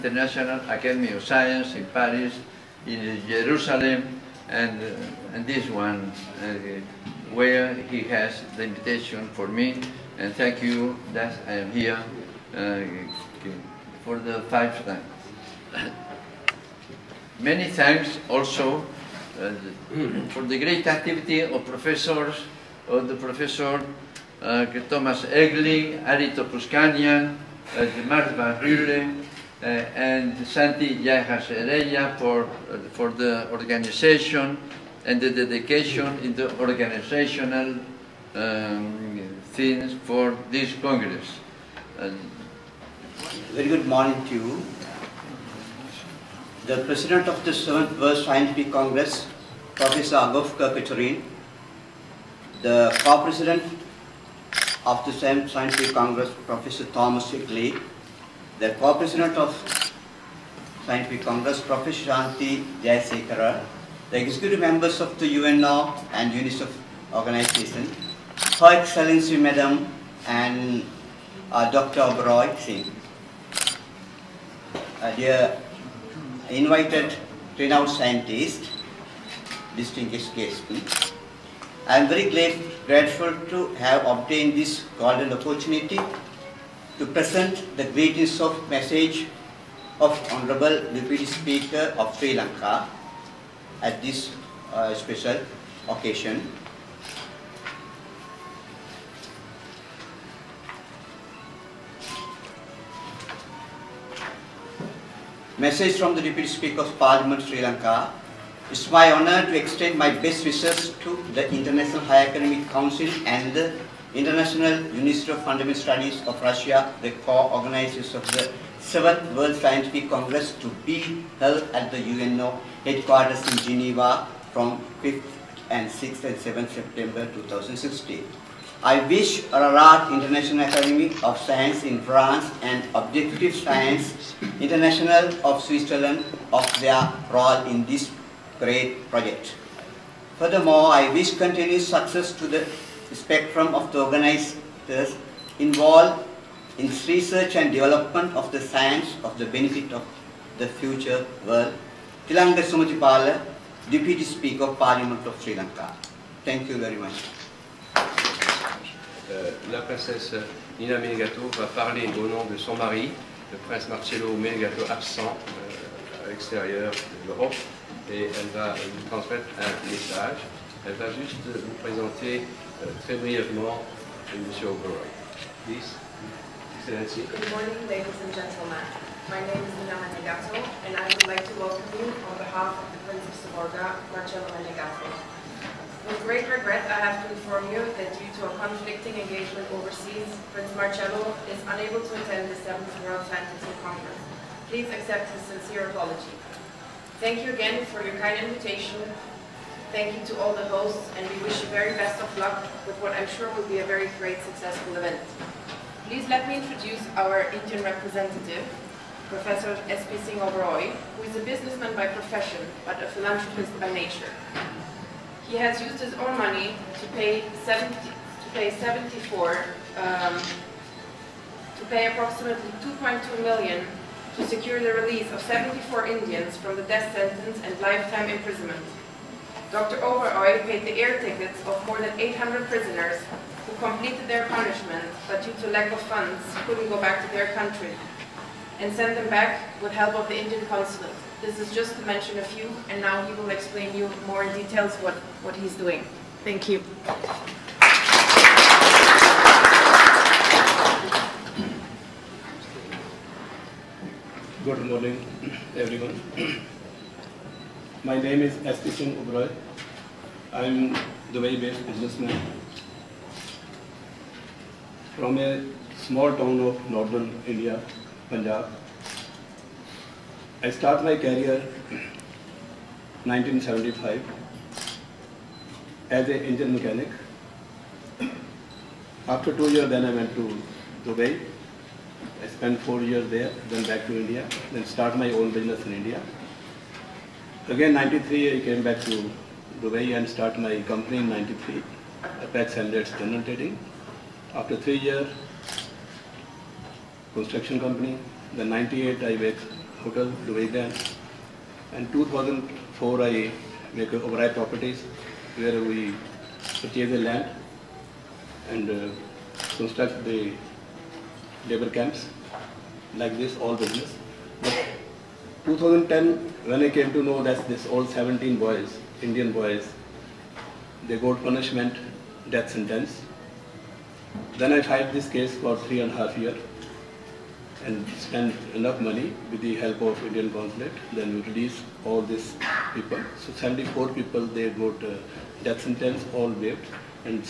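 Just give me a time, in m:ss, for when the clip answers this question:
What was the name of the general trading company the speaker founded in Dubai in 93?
4:52.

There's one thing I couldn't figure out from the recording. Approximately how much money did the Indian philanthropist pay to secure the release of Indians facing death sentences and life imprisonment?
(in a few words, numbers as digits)
2.2 million.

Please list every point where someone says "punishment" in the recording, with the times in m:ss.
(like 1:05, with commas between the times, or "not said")
3:54, 5:21.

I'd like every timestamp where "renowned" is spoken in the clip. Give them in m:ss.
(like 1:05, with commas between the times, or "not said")
1:17.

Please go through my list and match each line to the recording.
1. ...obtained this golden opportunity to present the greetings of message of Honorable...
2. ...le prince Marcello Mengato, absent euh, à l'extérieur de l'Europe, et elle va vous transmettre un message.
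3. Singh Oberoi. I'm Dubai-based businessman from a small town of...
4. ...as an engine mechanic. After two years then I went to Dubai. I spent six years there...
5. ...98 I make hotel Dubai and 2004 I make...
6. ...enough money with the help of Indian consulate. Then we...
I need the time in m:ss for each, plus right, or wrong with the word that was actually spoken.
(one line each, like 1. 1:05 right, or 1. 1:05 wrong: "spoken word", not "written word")
1. 1:24 right
2. 2:43 right
3. 4:18 right
4. 4:36 wrong: "four", not "six"
5. 4:58 right
6. 5:28 right.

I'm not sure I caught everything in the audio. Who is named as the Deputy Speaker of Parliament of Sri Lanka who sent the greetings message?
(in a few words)
Tilanga Sumatipala.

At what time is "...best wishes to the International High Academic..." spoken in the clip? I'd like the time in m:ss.
1:50.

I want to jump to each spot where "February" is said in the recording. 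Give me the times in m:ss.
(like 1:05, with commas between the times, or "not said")
not said.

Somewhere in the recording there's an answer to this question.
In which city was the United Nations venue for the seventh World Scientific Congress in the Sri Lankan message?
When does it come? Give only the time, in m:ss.
2:03.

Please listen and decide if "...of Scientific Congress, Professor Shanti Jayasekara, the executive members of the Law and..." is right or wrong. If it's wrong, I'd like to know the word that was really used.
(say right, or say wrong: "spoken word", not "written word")
right.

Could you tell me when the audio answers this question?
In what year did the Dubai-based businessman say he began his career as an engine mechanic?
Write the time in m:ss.
4:31.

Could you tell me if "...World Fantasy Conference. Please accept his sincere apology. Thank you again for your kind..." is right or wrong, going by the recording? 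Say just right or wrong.
right.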